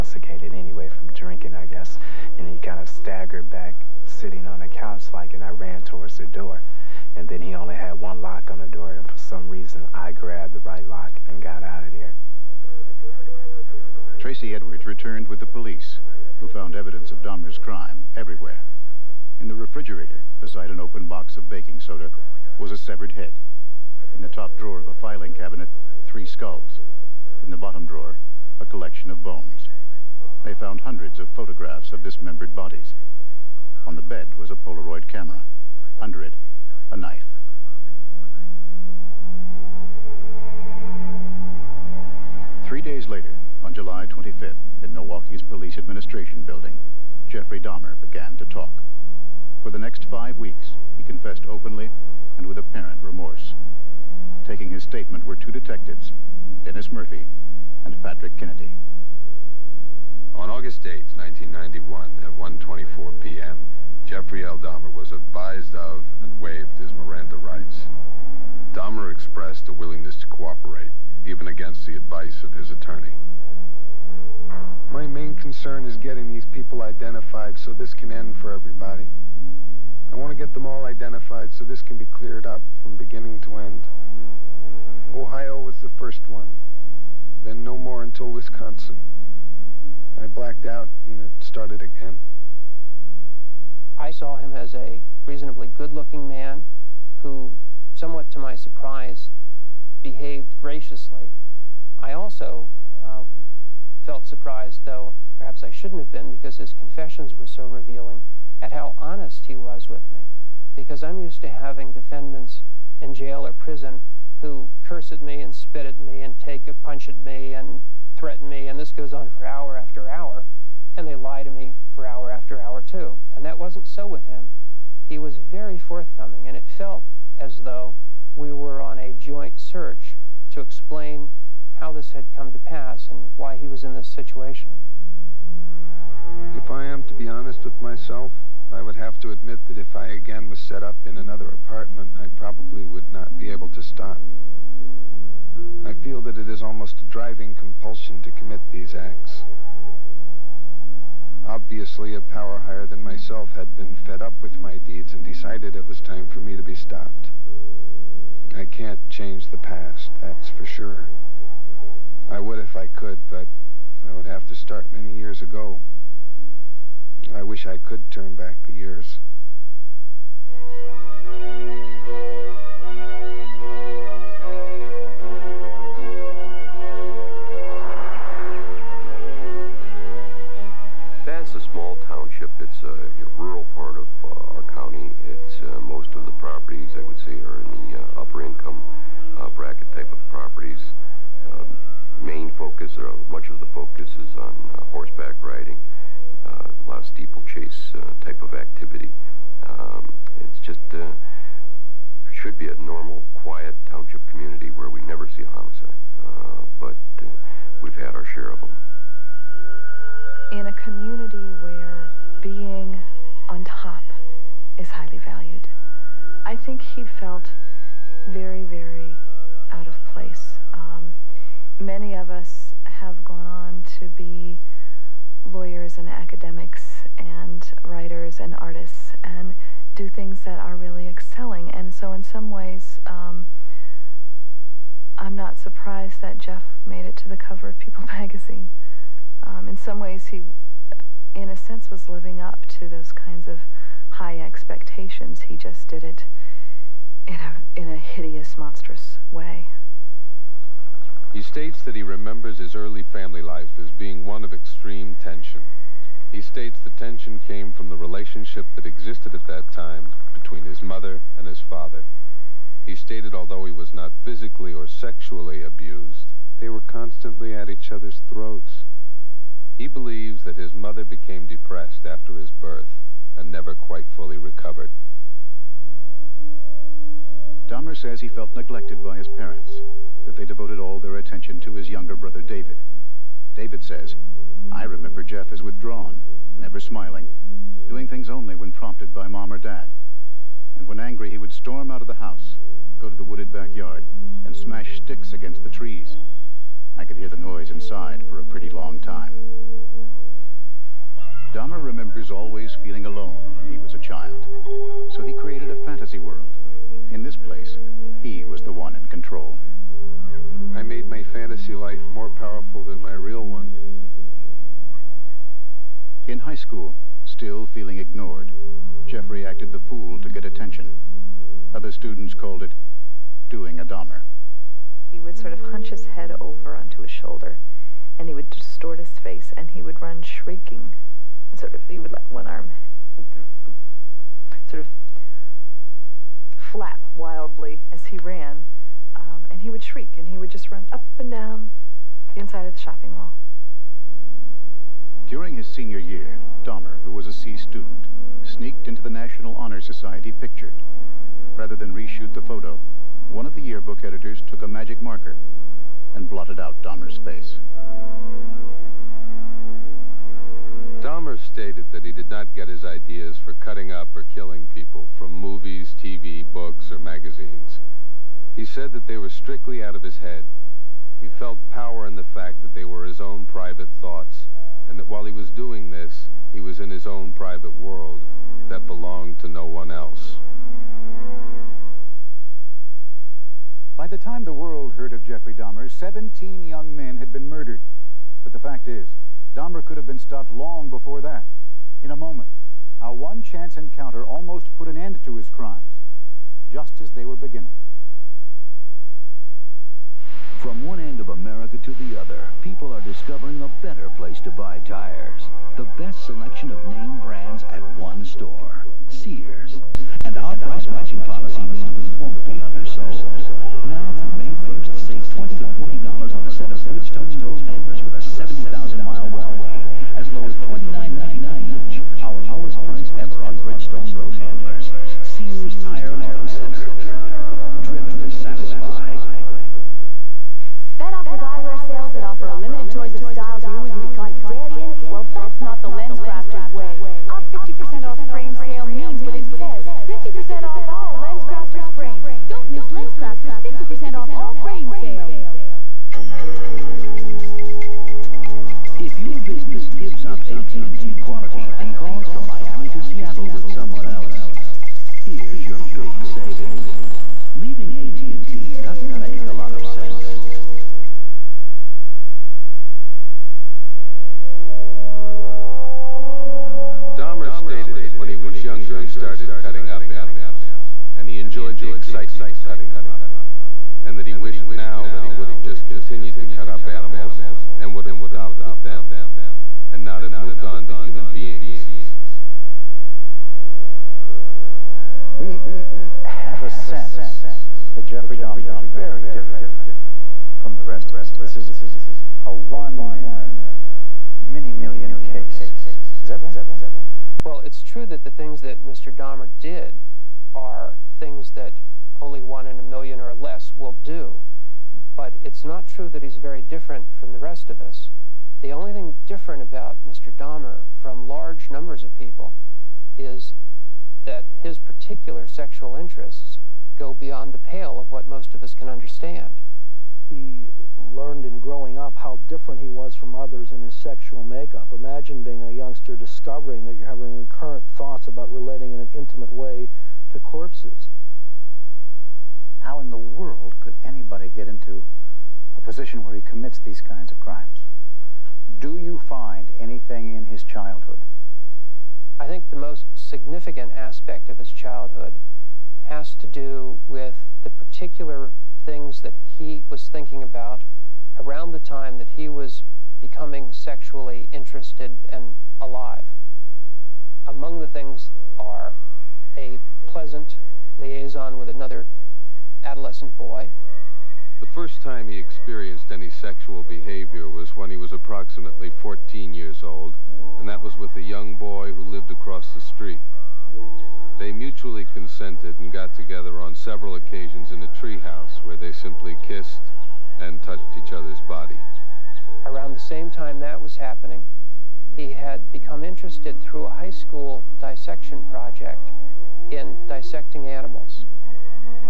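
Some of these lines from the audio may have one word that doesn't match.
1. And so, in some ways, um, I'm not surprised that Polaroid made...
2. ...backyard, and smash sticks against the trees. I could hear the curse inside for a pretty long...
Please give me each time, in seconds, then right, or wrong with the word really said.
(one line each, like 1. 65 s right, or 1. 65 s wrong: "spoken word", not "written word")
1. 231 s wrong: "Jeff", not "Polaroid"
2. 293 s wrong: "noise", not "curse".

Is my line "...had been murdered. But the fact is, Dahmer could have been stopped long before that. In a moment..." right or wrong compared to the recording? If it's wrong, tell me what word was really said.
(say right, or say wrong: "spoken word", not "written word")
right.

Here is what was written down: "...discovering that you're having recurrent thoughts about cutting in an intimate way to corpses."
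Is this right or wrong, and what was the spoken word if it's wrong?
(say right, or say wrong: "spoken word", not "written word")
wrong: "relating", not "cutting".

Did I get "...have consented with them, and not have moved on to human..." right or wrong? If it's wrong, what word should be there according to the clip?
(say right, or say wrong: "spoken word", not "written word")
wrong: "stopped", not "consented".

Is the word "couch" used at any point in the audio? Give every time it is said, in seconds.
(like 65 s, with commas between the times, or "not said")
4 s.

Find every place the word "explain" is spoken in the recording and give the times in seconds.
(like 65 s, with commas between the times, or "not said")
130 s.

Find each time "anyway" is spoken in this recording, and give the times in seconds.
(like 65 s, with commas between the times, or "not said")
0 s.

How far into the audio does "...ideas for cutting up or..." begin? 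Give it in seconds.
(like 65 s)
362 s.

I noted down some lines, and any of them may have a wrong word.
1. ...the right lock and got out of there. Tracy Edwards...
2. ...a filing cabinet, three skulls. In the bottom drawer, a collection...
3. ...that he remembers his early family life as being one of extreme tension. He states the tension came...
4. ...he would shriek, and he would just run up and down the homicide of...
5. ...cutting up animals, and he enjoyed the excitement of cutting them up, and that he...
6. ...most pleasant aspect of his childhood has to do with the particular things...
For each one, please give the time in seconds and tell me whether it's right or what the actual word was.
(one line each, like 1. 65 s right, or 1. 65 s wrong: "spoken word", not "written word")
1. 10 s right
2. 24 s right
3. 251 s right
4. 339 s wrong: "inside", not "homicide"
5. 469 s right
6. 542 s wrong: "significant", not "pleasant".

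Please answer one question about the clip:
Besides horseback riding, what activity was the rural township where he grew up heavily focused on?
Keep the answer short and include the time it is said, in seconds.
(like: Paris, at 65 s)
Steeplechase, at 197 s.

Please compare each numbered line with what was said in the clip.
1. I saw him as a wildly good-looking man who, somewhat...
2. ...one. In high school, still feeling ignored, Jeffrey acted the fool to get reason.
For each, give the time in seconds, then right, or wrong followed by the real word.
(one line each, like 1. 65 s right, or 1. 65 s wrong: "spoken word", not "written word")
1. 93 s wrong: "reasonably", not "wildly"
2. 313 s wrong: "attention", not "reason".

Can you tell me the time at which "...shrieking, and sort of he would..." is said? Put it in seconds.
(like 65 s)
330 s.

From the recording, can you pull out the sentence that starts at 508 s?
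The only thing different about Mr.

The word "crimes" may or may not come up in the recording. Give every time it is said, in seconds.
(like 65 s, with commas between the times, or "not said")
17 s, 395 s, 537 s.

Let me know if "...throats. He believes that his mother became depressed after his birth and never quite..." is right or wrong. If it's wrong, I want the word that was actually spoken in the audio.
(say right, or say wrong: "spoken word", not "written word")
right.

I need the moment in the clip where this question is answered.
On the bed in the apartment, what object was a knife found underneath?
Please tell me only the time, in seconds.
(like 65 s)
34 s.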